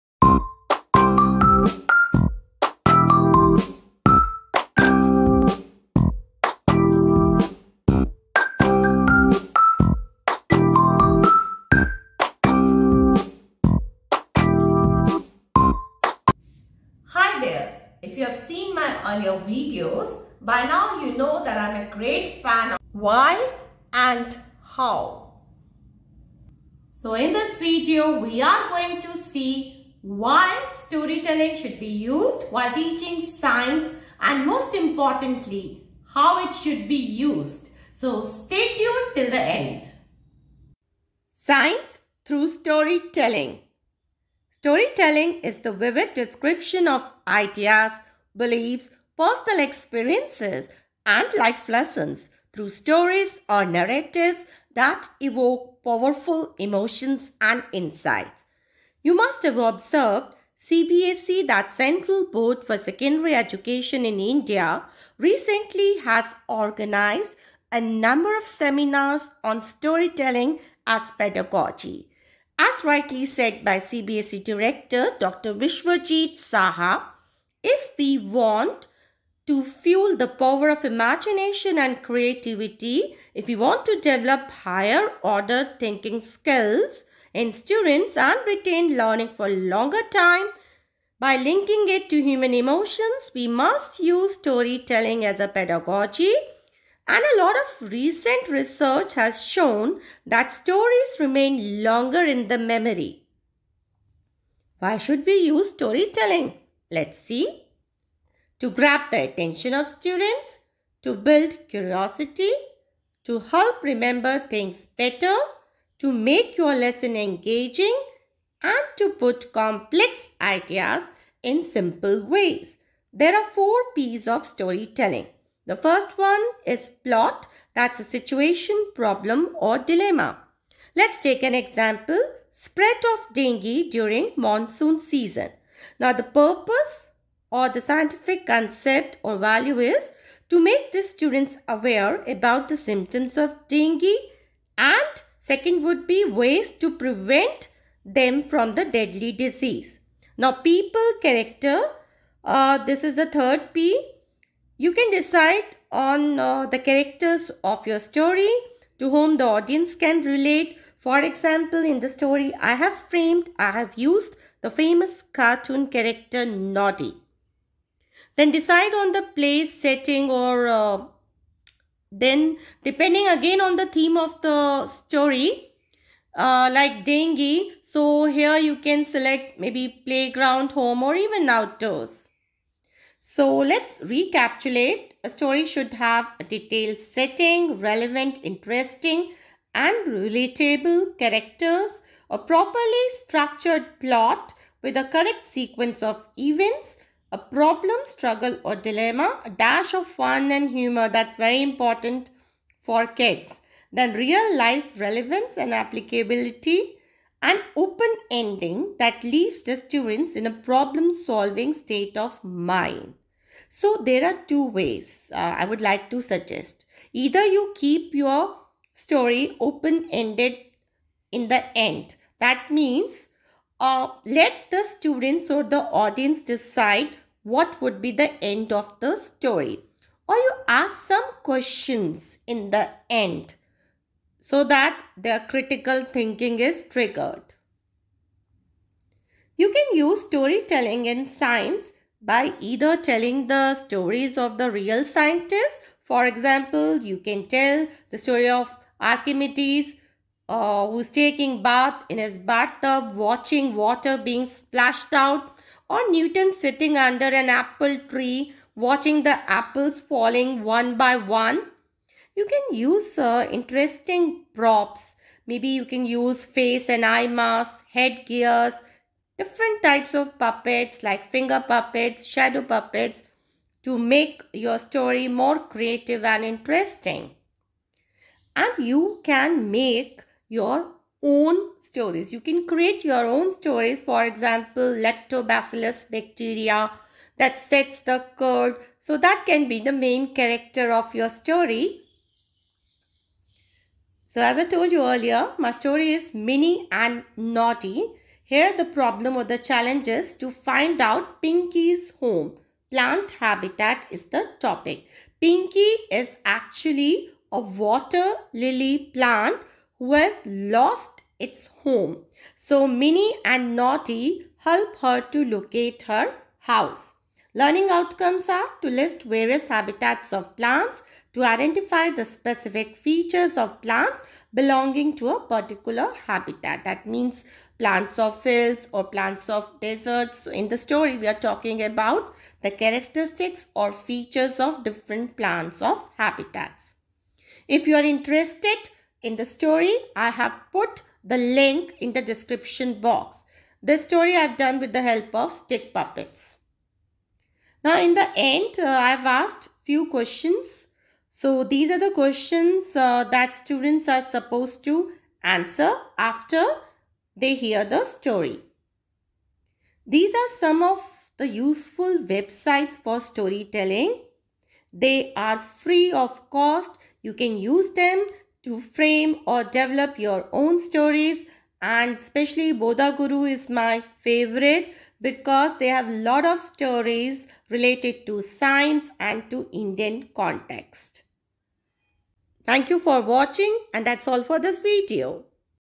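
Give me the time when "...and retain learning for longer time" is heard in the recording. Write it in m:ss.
1:28.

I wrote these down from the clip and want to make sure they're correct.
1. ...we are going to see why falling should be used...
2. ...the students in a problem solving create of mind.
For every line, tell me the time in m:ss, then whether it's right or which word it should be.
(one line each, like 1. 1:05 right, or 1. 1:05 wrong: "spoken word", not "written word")
1. 0:28 wrong: "storytelling", not "falling"
2. 3:29 wrong: "state", not "create".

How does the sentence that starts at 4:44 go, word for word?
For example, lactobacillus bacteria that sets the curd.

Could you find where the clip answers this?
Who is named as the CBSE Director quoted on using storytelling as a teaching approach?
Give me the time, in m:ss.
1:15.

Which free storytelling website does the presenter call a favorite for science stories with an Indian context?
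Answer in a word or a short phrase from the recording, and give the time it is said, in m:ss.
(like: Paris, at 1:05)
Bodha Guru, at 6:12.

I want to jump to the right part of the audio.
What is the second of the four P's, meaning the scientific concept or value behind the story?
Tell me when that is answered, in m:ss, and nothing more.
2:16.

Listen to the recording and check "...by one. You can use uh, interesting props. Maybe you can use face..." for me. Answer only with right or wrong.
right.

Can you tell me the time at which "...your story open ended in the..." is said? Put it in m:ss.
3:38.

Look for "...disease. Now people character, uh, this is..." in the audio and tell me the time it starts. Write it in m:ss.
2:29.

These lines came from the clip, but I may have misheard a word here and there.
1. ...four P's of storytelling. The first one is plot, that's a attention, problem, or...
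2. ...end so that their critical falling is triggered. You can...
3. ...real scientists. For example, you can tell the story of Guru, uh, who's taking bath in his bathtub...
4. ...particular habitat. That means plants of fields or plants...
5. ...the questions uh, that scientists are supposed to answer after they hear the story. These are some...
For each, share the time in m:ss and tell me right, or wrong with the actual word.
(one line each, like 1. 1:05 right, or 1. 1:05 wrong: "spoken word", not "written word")
1. 2:03 wrong: "situation", not "attention"
2. 3:53 wrong: "thinking", not "falling"
3. 4:04 wrong: "Archimedes", not "Guru"
4. 5:25 right
5. 5:51 wrong: "students", not "scientists".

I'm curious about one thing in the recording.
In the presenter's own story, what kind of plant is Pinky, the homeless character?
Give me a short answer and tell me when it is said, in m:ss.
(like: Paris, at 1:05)
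A water lily, at 5:07.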